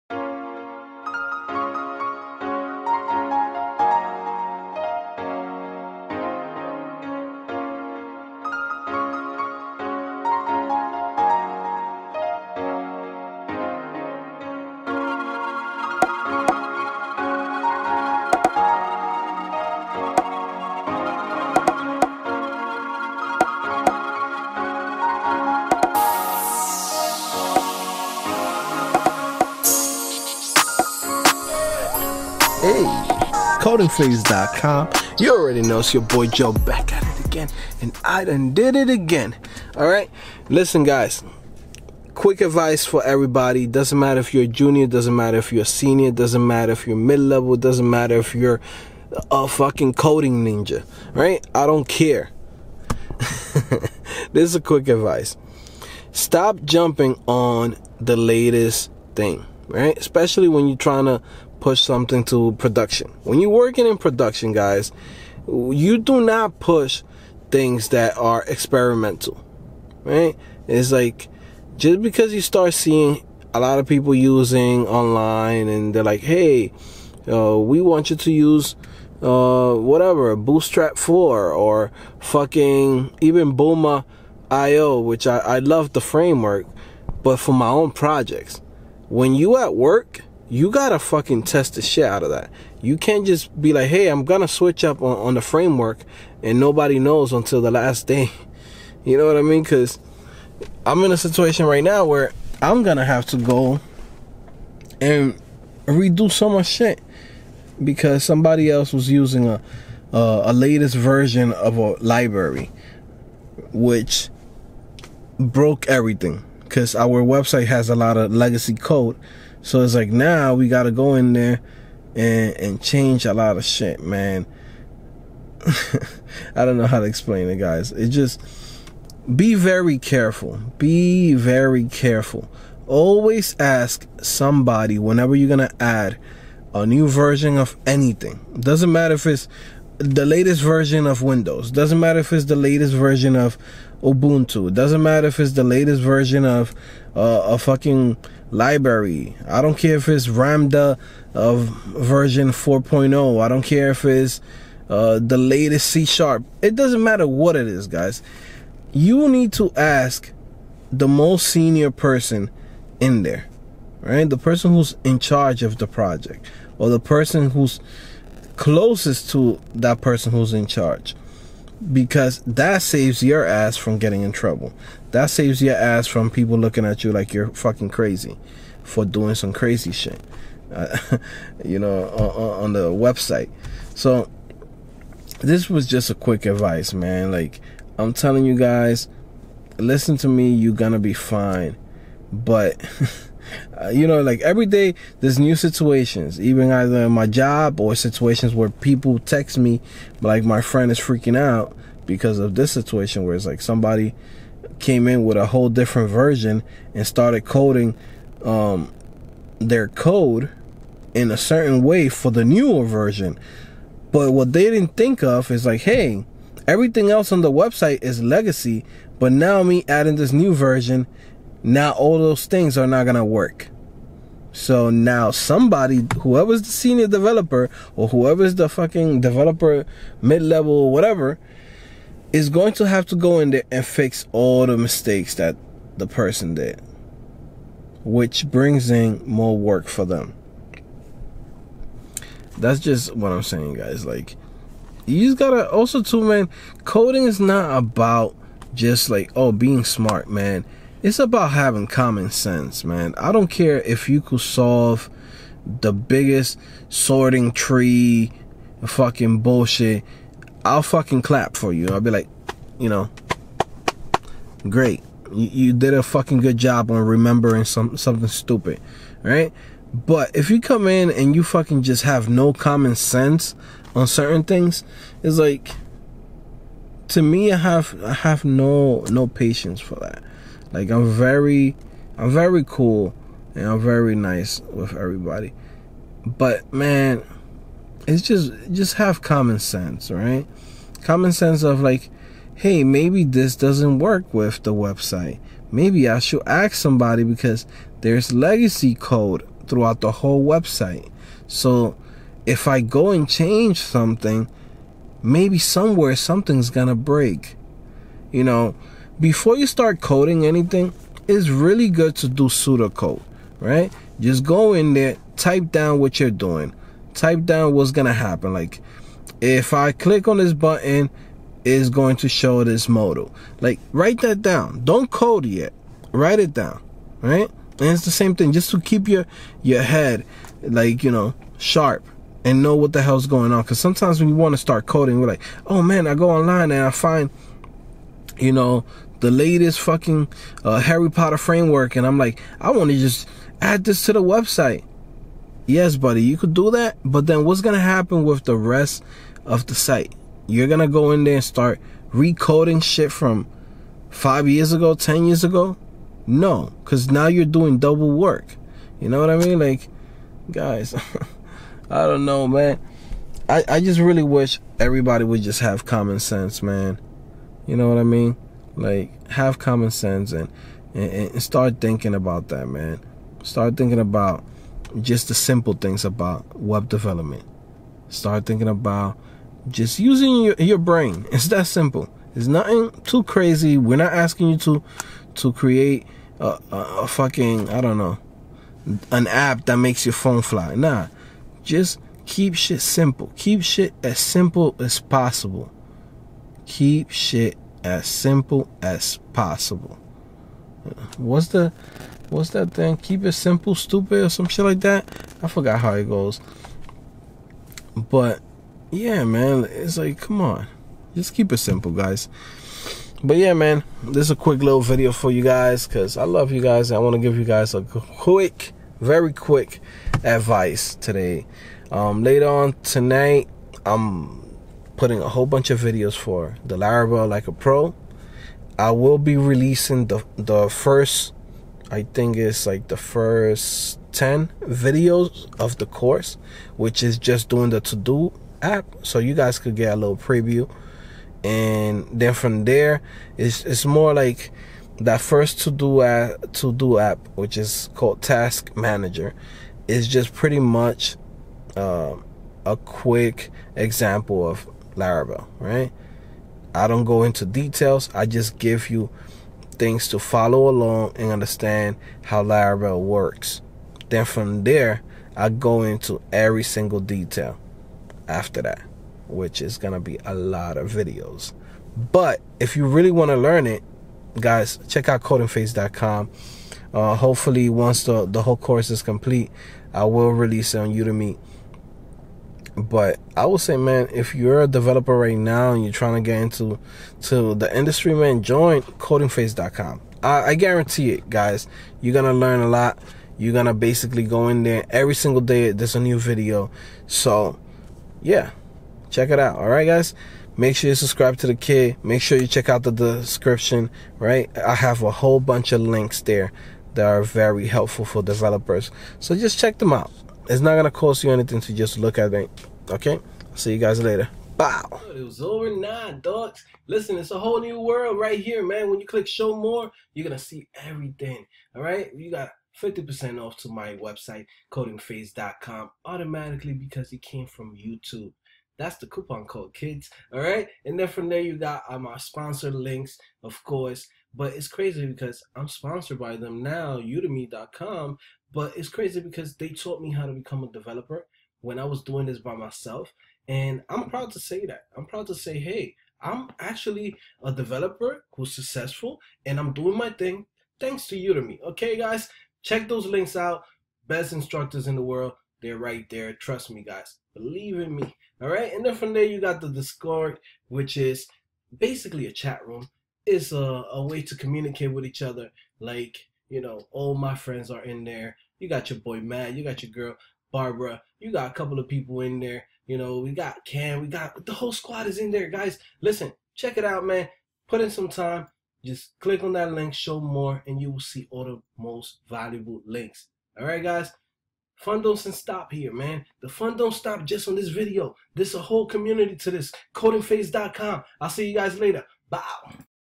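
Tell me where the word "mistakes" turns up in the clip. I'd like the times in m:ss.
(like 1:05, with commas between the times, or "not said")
3:54.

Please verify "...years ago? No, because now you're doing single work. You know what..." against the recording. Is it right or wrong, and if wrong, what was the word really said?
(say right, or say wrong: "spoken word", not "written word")
wrong: "double", not "single".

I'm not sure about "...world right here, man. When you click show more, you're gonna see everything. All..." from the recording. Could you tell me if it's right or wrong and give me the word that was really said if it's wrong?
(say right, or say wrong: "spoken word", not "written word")
right.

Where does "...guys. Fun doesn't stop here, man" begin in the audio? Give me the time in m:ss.
9:43.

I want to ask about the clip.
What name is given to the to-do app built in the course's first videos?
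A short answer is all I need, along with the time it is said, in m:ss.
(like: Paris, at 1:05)
Task Manager, at 7:28.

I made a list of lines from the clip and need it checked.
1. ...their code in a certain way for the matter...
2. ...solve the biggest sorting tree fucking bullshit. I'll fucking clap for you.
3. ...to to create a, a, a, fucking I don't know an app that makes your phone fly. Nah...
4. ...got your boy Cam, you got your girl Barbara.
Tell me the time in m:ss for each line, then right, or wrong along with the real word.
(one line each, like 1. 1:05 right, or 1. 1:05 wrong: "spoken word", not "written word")
1. 3:29 wrong: "newer", not "matter"
2. 4:14 right
3. 6:24 right
4. 9:28 wrong: "Matt", not "Cam".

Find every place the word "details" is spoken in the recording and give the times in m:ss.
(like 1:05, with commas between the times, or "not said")
7:37, 7:46.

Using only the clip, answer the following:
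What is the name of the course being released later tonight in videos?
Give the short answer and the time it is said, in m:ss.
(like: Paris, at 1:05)
Laravel like a pro, at 7:06.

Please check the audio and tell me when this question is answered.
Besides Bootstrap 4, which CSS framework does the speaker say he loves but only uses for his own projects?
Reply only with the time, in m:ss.
1:23.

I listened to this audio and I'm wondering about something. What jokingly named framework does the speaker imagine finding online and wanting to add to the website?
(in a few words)
Harry Potter framework.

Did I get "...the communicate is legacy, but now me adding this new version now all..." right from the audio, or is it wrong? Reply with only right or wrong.
wrong.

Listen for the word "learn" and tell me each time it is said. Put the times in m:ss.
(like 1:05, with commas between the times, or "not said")
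7:53, 8:12.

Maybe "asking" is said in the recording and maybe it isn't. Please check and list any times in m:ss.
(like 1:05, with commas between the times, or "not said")
6:24.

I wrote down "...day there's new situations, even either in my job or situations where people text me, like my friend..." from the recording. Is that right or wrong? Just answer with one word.
right.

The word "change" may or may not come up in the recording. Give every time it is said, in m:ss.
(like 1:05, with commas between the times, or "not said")
2:02, 5:03.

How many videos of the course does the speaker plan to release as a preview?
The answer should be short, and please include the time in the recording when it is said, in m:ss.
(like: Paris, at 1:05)
10, at 7:14.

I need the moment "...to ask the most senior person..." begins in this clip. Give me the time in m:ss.
2:39.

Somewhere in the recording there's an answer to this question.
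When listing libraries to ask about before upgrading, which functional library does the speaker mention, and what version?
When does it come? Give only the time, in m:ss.
2:30.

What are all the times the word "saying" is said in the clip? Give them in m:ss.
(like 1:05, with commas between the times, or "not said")
4:03.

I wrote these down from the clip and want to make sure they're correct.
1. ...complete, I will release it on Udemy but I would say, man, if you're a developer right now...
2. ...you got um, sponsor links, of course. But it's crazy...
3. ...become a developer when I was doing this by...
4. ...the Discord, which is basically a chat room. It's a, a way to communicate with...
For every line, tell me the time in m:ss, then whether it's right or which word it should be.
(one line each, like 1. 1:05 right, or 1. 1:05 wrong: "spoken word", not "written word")
1. 7:59 right
2. 8:51 right
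3. 9:00 right
4. 9:19 right.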